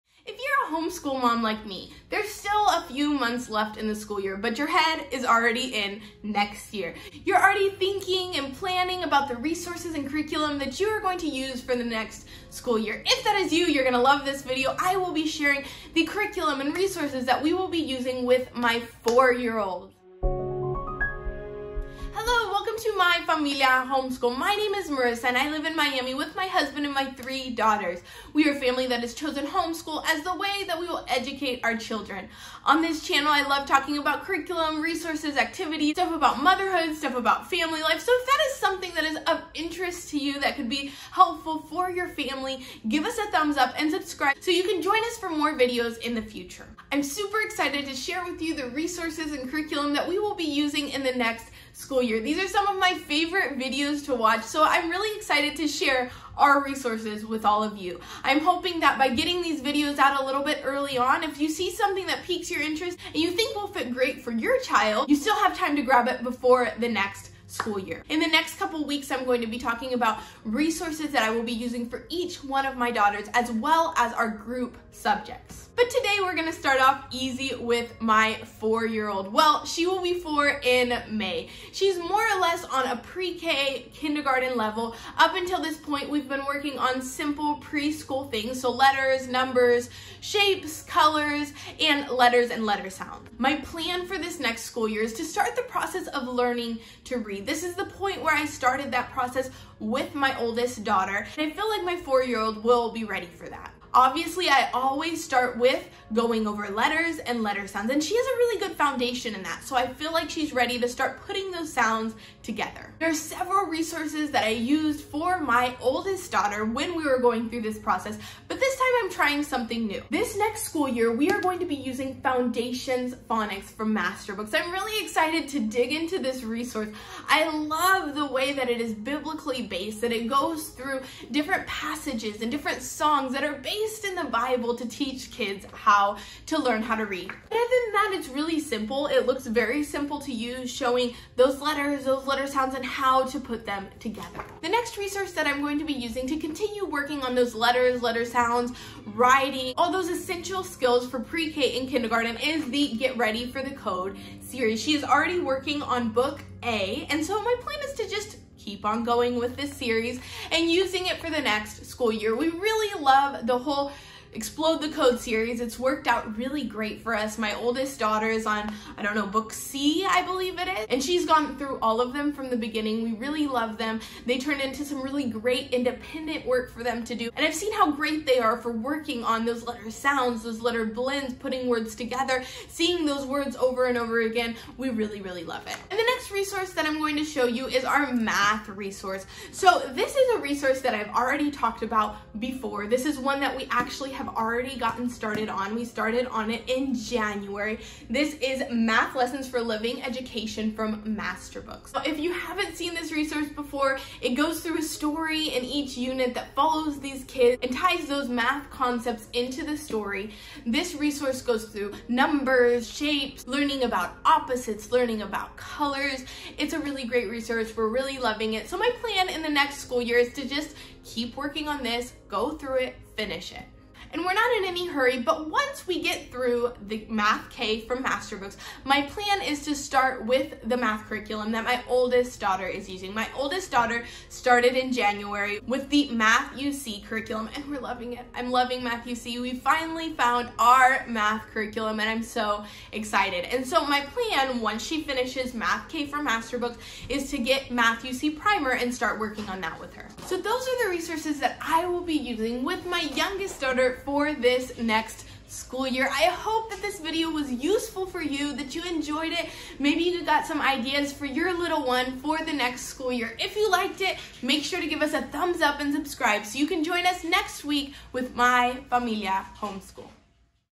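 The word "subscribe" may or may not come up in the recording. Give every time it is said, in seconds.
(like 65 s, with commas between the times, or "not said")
43 s, 265 s.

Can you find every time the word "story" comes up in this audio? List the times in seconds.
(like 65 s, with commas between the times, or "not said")
204 s, 209 s.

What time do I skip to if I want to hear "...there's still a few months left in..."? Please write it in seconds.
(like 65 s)
2 s.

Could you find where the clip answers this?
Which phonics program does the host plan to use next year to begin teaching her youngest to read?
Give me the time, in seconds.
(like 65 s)
122 s.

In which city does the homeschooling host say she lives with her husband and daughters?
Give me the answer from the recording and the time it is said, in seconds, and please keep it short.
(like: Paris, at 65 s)
Miami, at 25 s.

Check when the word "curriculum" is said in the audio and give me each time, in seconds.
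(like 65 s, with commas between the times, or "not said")
10 s, 16 s, 34 s, 49 s, 231 s, 237 s, 241 s.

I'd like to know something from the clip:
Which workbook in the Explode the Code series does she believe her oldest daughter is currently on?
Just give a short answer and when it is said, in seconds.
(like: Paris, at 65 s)
Book C, at 169 s.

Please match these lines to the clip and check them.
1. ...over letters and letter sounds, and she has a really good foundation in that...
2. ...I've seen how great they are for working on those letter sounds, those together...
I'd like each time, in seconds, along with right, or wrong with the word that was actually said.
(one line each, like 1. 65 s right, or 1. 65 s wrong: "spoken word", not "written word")
1. 106 s right
2. 177 s wrong: "letter", not "together".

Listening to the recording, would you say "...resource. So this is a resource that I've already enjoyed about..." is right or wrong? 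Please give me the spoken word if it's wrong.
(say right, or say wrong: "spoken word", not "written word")
wrong: "talked", not "enjoyed".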